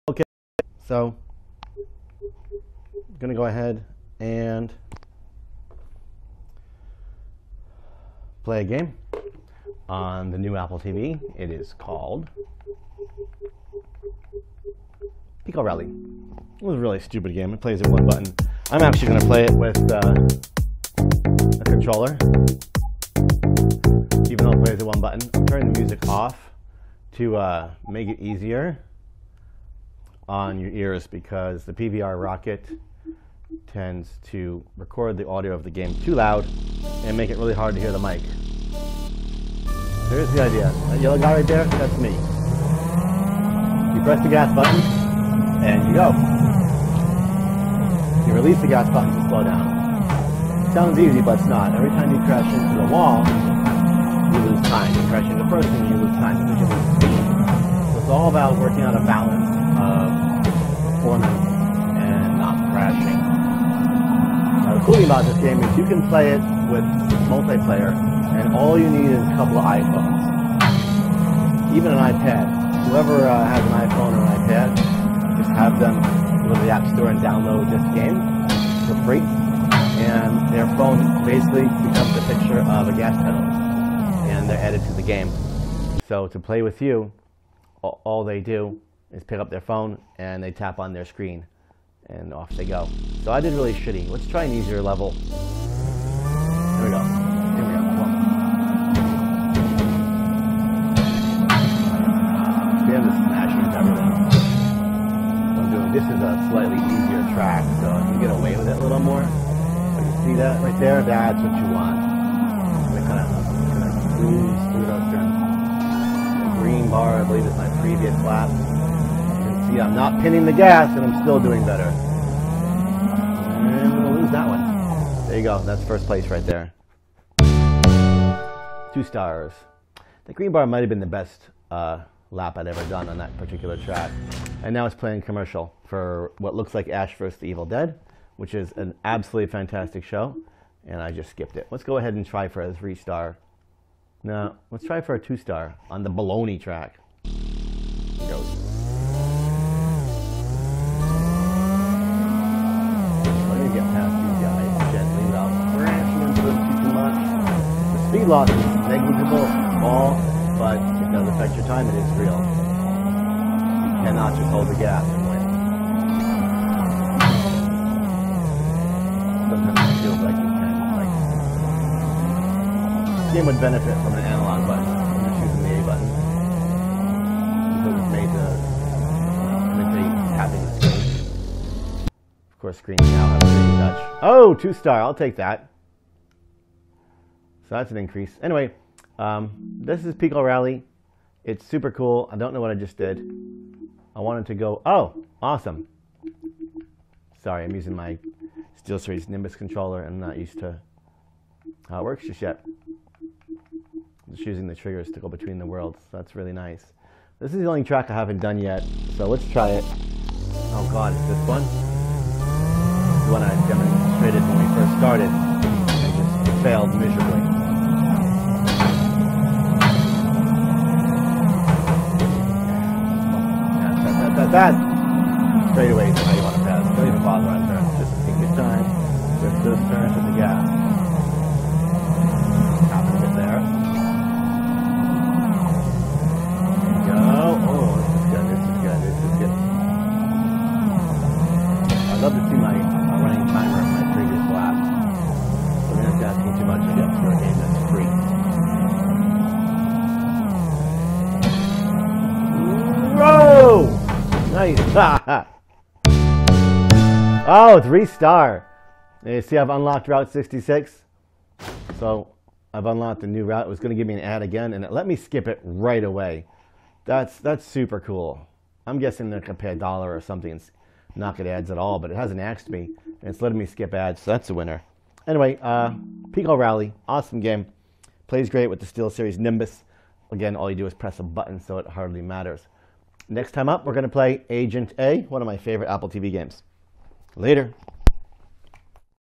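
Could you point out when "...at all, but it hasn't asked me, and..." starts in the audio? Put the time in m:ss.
4:31.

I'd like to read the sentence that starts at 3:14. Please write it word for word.
I wanted to go, oh, awesome.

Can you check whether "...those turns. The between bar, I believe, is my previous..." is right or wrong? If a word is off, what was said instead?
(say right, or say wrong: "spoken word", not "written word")
wrong: "green", not "between".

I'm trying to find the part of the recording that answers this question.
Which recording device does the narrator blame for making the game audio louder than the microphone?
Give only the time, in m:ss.
0:31.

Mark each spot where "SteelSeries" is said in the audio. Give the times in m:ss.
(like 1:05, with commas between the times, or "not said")
3:18, 4:38.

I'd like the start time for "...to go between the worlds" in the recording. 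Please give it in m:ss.
3:25.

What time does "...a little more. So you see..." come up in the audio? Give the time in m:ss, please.
1:48.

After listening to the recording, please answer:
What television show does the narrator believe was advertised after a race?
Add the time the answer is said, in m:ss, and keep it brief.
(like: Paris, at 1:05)
Ash vs. the Evil Dead, at 2:16.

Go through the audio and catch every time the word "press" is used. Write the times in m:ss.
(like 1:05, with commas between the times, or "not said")
0:44, 4:40.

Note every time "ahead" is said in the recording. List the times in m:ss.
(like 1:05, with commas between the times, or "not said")
0:03, 2:21.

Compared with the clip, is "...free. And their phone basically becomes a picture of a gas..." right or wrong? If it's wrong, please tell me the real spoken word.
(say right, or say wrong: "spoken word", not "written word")
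right.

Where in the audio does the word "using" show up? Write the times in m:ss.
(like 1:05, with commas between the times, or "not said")
3:17, 3:24.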